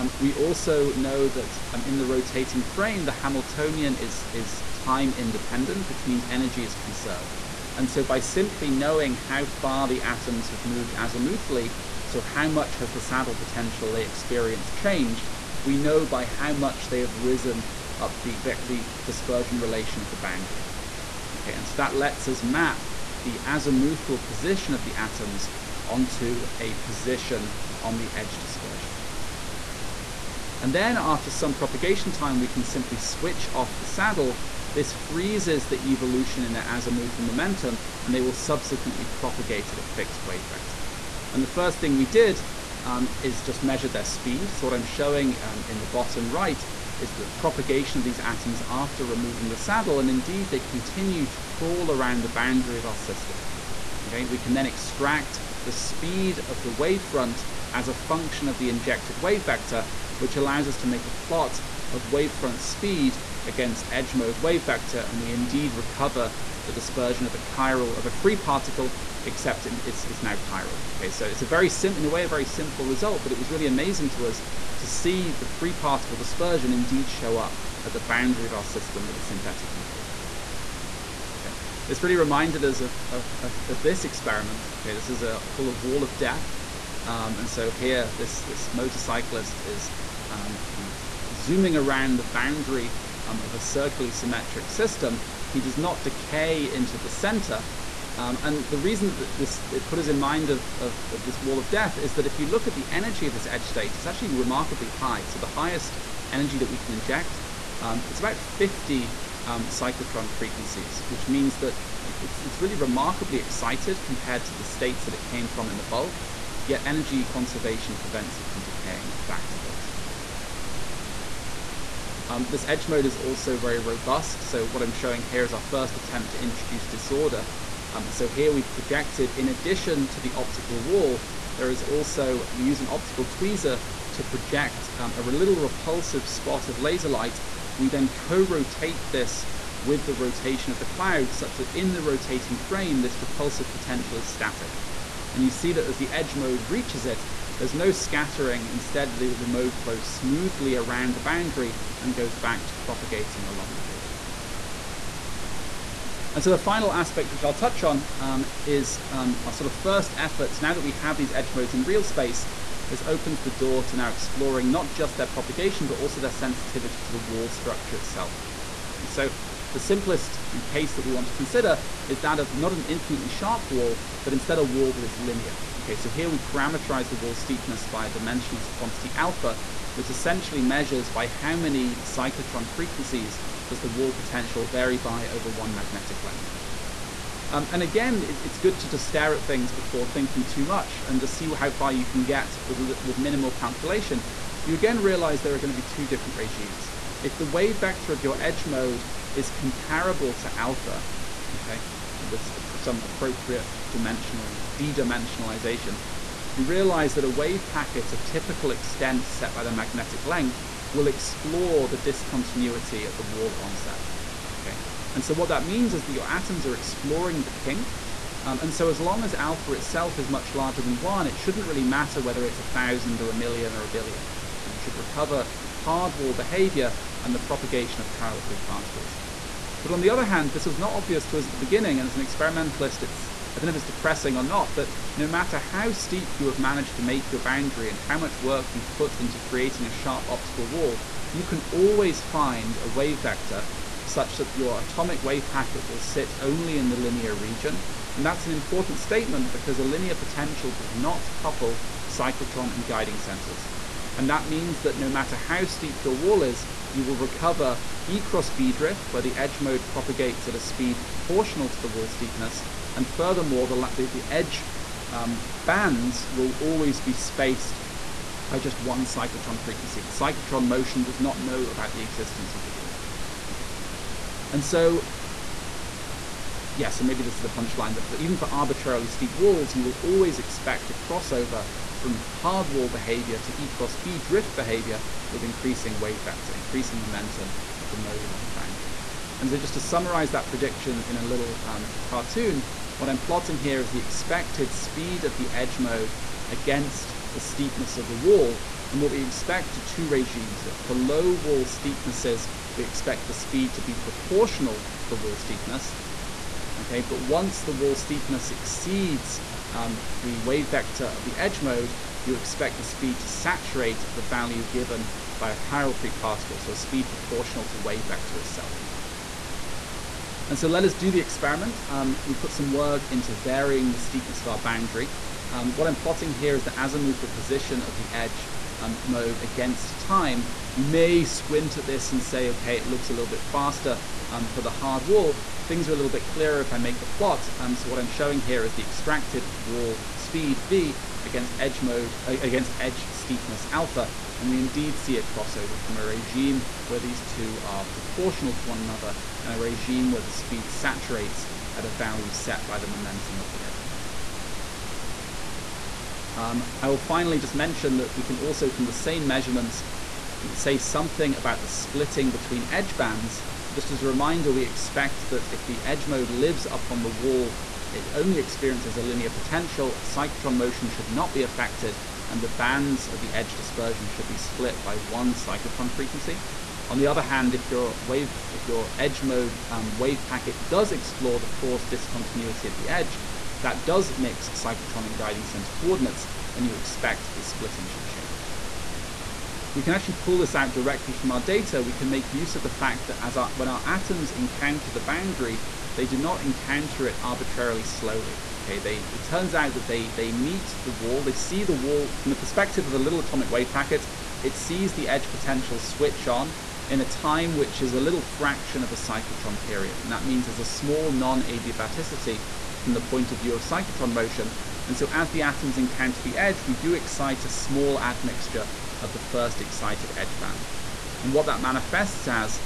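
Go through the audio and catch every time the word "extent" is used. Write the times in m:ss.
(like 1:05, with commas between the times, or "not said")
3:28.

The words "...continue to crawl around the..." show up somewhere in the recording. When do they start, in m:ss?
0:50.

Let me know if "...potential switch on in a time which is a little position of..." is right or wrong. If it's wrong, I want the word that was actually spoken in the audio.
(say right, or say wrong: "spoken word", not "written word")
wrong: "fraction", not "position".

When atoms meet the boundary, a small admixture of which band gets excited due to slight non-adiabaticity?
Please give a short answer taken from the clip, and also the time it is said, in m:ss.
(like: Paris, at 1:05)
First excited edge band, at 6:59.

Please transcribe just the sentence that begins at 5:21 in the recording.
Um, we put some work into varying the steepness of our boundary.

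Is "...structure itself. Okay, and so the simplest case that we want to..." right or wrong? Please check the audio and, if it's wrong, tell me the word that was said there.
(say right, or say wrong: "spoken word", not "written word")
right.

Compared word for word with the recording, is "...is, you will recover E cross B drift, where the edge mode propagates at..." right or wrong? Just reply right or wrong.
right.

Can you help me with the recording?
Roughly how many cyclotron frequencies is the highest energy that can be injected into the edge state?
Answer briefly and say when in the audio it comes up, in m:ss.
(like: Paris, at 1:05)
50, at 1:48.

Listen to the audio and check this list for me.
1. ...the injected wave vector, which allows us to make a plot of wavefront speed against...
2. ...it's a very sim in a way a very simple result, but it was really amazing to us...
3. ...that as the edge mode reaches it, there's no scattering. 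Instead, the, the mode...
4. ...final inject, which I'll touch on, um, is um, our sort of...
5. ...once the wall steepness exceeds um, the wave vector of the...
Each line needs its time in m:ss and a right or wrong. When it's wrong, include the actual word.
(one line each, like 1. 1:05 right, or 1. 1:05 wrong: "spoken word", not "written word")
1. 0:58 right
2. 1:11 right
3. 2:25 right
4. 2:36 wrong: "aspect", not "inject"
5. 5:07 right.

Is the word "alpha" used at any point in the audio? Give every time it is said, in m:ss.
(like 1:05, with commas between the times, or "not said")
2:59, 3:20, 3:39, 5:43.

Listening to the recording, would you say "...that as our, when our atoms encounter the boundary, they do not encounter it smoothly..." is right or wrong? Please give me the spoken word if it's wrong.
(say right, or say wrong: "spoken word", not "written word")
wrong: "arbitrarily", not "smoothly".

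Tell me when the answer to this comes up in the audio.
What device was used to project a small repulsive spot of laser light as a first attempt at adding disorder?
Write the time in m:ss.
2:12.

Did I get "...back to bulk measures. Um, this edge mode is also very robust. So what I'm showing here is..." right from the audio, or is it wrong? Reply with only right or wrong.
wrong.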